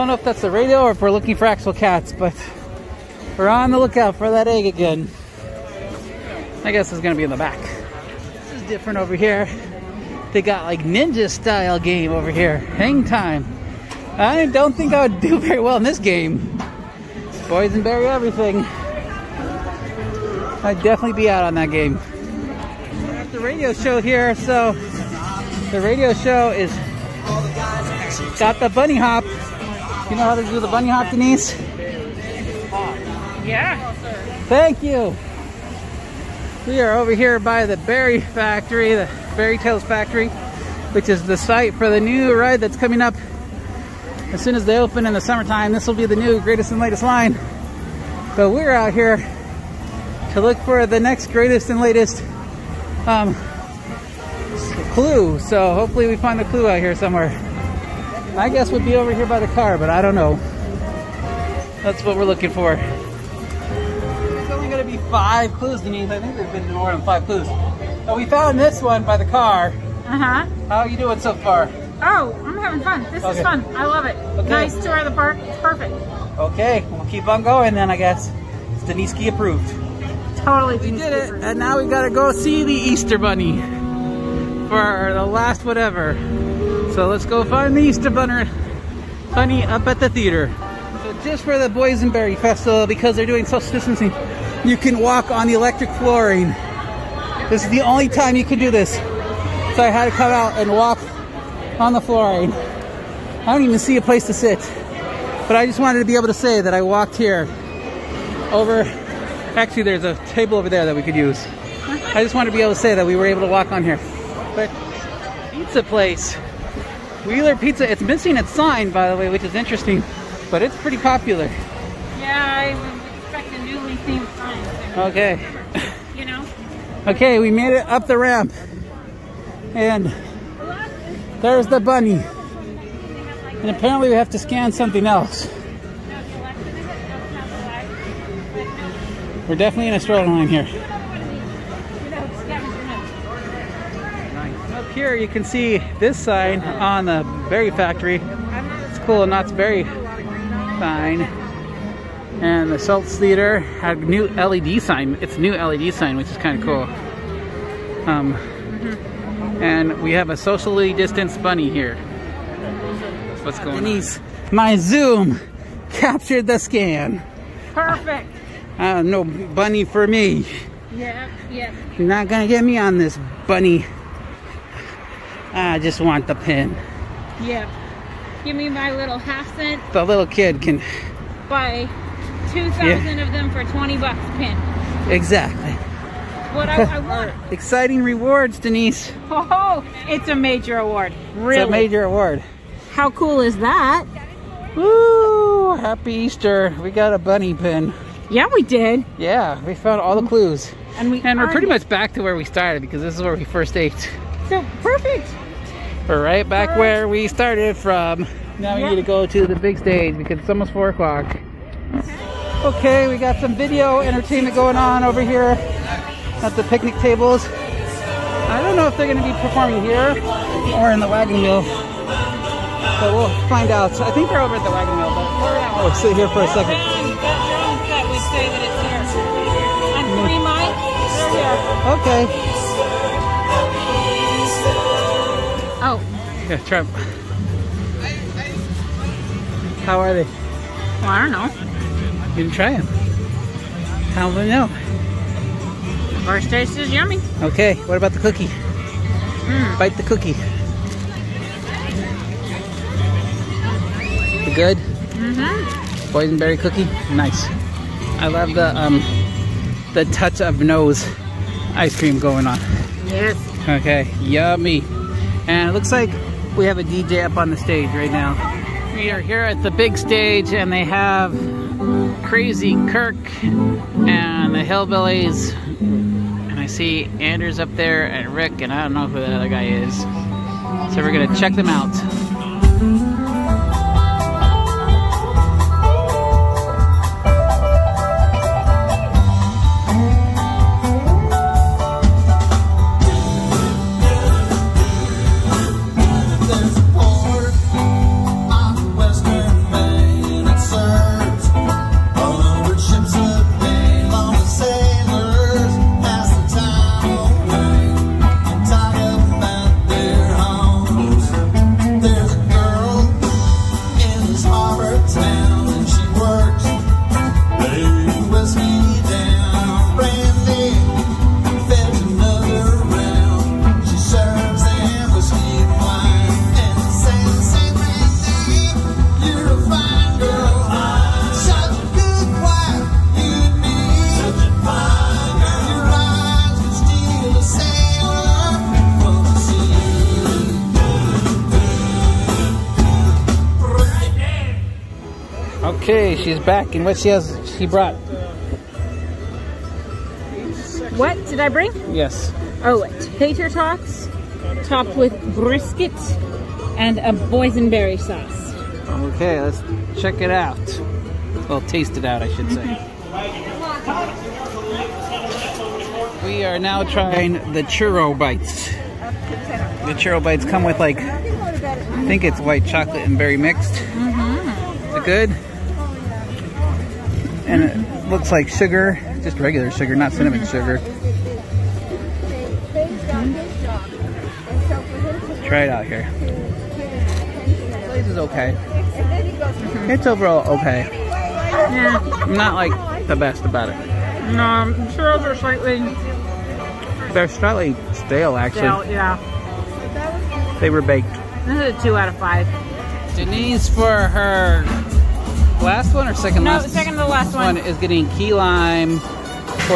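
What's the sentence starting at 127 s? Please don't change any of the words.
Okay, we made it up the ramp.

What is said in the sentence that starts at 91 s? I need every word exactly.
So just for the Boysenberry Festival, because they're doing social distancing, you can walk on the electric flooring.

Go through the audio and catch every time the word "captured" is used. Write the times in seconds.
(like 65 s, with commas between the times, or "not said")
165 s.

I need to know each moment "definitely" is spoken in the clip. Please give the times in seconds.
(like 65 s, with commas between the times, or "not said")
20 s, 139 s.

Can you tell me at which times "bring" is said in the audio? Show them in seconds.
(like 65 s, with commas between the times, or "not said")
351 s.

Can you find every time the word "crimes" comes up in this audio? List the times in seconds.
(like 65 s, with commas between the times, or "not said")
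not said.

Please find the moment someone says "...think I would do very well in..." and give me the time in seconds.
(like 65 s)
14 s.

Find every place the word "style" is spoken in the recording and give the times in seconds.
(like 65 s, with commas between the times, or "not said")
11 s.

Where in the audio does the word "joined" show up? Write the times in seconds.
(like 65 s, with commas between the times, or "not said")
not said.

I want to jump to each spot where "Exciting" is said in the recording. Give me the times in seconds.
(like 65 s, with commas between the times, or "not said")
187 s.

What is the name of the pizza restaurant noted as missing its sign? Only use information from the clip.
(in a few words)
Wheeler Pizza.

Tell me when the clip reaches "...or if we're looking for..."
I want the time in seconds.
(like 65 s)
0 s.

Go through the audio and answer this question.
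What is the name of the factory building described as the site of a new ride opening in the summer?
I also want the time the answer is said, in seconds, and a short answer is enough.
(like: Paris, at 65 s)
Berry Tales Factory, at 39 s.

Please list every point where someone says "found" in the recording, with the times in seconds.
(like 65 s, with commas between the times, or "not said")
68 s, 199 s.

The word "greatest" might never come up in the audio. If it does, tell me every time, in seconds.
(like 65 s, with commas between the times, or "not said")
46 s, 51 s.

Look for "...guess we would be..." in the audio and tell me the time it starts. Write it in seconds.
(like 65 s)
58 s.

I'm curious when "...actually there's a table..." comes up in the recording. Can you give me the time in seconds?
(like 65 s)
109 s.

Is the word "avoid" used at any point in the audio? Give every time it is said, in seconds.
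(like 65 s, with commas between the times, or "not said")
not said.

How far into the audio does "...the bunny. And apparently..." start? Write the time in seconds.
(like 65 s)
131 s.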